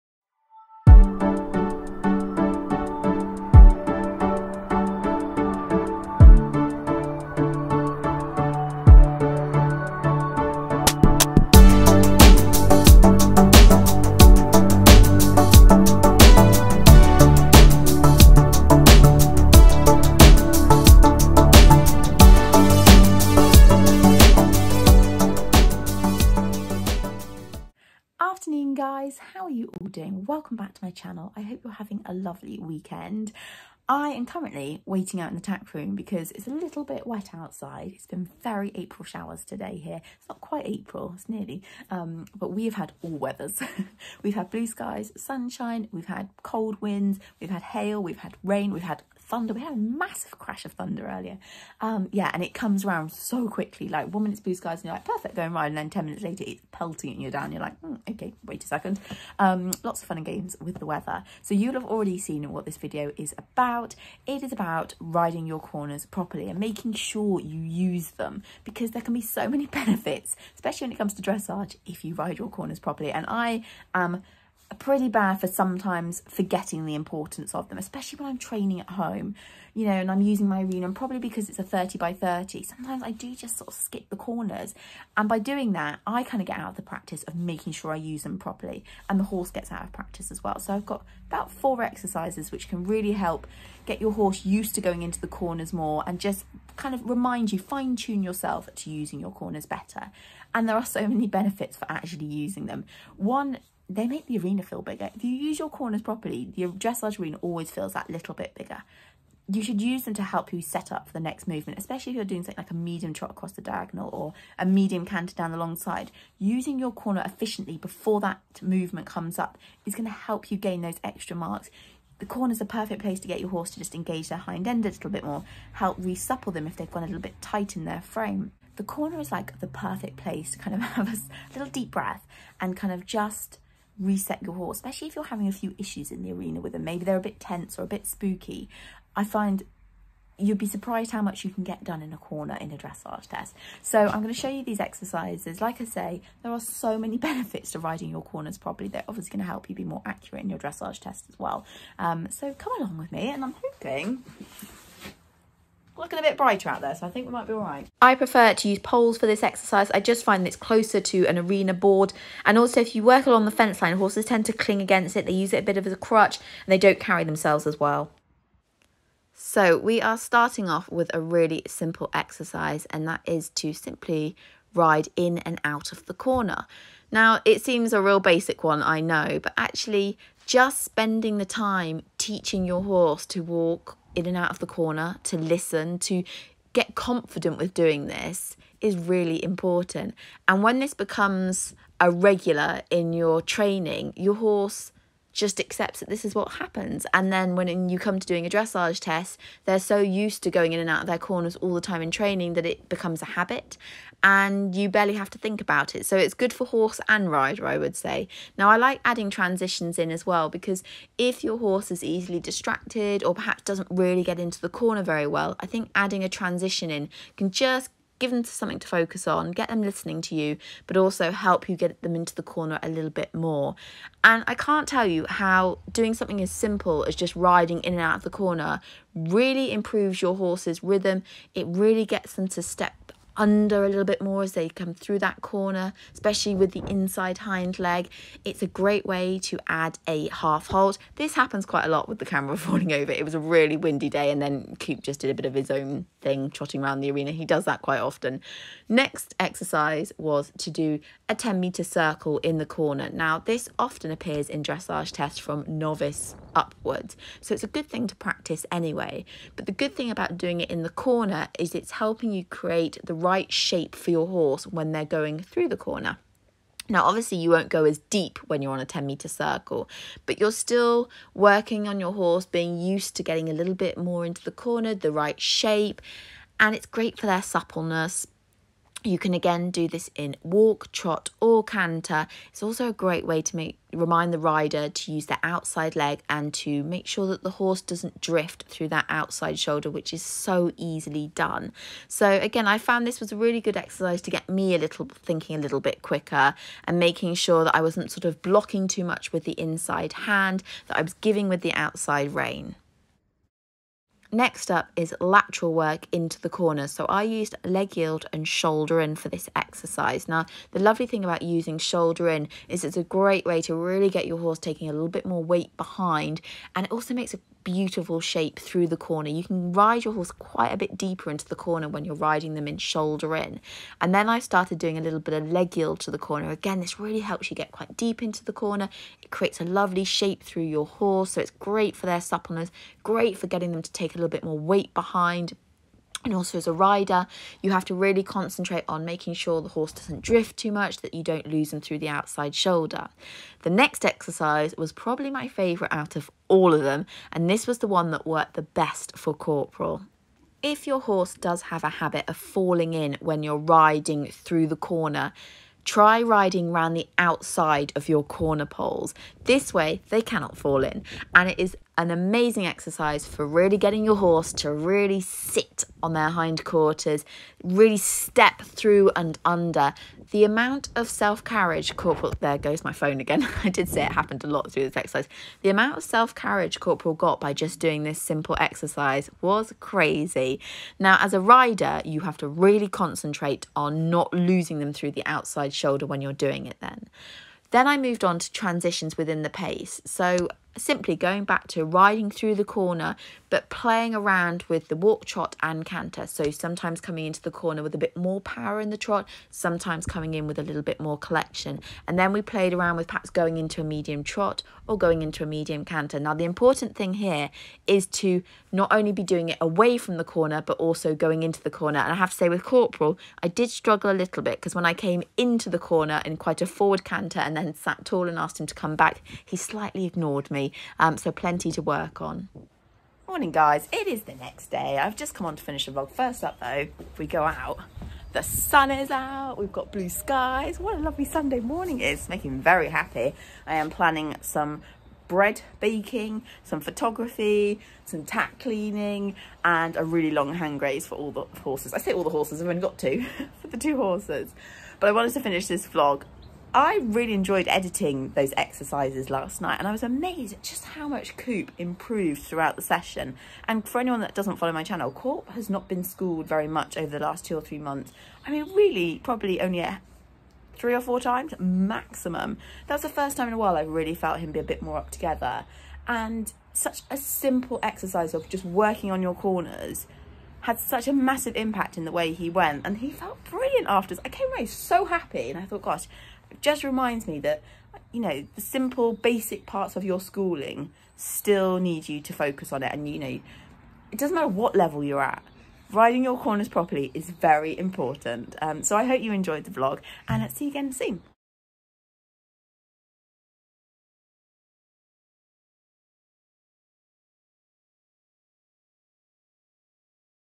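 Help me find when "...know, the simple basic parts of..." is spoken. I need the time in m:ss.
7:58.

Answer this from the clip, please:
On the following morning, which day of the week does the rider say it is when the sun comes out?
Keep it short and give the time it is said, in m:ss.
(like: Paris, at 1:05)
Sunday, at 7:11.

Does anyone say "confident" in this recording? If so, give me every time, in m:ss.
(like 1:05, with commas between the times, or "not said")
3:06.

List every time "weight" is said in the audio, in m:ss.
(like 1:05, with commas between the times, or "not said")
5:15, 5:34.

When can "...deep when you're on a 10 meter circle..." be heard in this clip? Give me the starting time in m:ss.
4:28.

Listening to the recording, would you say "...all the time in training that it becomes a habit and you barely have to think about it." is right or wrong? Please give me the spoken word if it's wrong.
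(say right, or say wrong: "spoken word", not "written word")
right.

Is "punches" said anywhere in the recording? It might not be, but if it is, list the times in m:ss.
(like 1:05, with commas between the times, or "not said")
not said.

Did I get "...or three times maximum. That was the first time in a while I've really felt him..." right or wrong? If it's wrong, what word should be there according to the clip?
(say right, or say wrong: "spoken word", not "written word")
wrong: "four", not "three".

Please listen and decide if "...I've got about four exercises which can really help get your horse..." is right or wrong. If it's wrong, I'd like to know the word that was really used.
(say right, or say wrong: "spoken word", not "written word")
right.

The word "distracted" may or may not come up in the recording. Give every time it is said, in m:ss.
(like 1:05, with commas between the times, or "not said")
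3:32.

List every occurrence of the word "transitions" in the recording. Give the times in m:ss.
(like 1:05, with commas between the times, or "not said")
3:29, 3:36, 6:28.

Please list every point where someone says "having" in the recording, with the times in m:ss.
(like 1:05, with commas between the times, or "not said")
0:31, 2:15.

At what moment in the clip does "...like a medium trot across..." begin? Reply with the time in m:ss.
1:52.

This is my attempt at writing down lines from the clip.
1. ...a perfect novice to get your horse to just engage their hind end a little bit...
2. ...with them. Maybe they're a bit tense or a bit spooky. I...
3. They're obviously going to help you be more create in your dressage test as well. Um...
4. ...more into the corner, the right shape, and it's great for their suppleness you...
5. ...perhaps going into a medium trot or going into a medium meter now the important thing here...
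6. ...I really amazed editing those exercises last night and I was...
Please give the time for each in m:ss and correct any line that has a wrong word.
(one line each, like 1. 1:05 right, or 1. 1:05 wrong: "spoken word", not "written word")
1. 2:02 wrong: "place", not "novice"
2. 2:16 right
3. 2:28 wrong: "accurate", not "create"
4. 4:33 right
5. 6:43 wrong: "canter", not "meter"
6. 7:26 wrong: "enjoyed", not "amazed".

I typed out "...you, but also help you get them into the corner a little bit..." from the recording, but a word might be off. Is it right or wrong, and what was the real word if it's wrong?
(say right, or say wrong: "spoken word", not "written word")
right.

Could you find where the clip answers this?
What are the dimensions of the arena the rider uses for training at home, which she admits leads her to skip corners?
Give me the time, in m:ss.
1:21.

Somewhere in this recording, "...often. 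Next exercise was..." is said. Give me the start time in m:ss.
4:07.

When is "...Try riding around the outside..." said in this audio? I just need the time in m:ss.
5:55.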